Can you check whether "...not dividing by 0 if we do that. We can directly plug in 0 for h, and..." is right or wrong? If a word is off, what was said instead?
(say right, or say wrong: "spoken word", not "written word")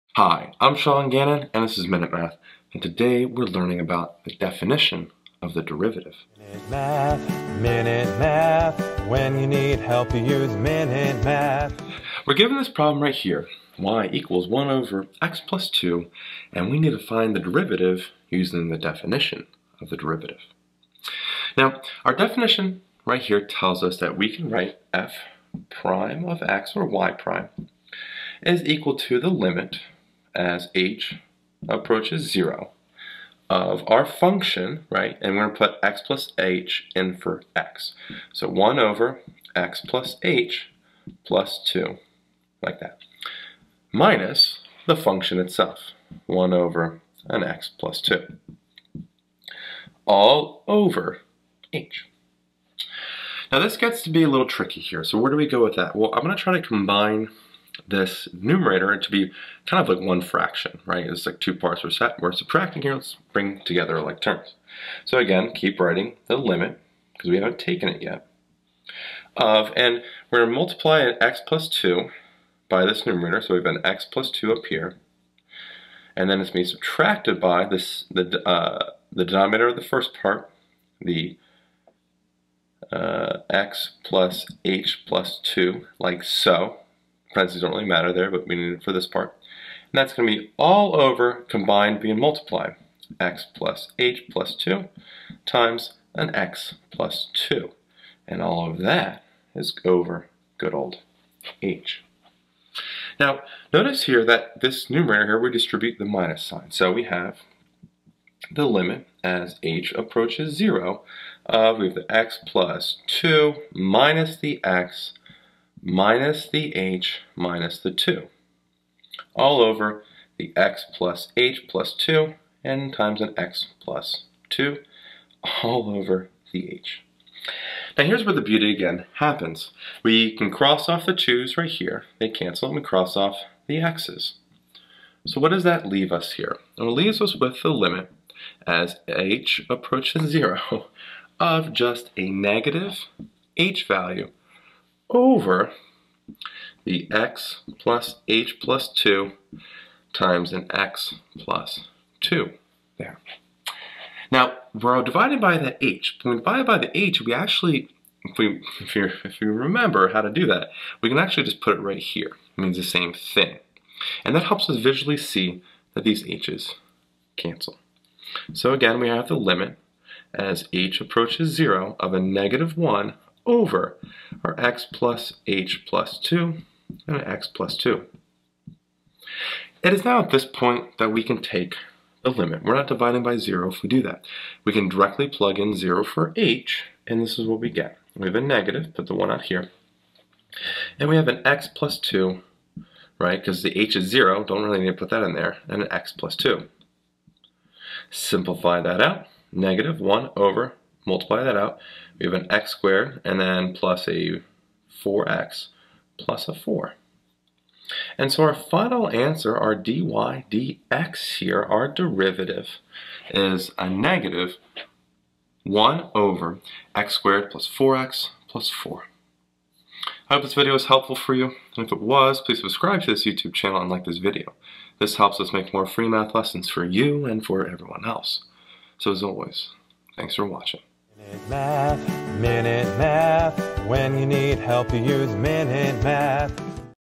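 right.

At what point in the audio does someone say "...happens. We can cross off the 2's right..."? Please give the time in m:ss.
2:09.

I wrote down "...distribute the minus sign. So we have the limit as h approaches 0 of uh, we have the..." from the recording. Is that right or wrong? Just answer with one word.
right.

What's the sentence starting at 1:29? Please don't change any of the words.
And that's going to be all over combined being multiplied.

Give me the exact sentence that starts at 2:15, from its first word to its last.
So what does that leave us here?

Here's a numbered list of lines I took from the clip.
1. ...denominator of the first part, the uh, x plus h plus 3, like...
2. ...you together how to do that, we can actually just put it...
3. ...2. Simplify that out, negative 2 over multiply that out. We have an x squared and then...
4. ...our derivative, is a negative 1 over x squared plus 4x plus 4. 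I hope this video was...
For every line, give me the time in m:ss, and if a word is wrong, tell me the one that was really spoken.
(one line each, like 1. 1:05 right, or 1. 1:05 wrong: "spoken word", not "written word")
1. 1:19 wrong: "2", not "3"
2. 2:39 wrong: "remember", not "together"
3. 3:16 wrong: "1", not "2"
4. 3:31 right.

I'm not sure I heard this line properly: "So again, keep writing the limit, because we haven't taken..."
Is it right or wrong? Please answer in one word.
right.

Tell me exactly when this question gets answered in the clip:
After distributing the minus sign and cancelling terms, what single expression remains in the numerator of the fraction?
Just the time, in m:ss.
2:22.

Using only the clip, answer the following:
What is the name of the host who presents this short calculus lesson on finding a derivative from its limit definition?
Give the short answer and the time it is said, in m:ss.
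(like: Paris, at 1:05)
Sean Gannon, at 0:00.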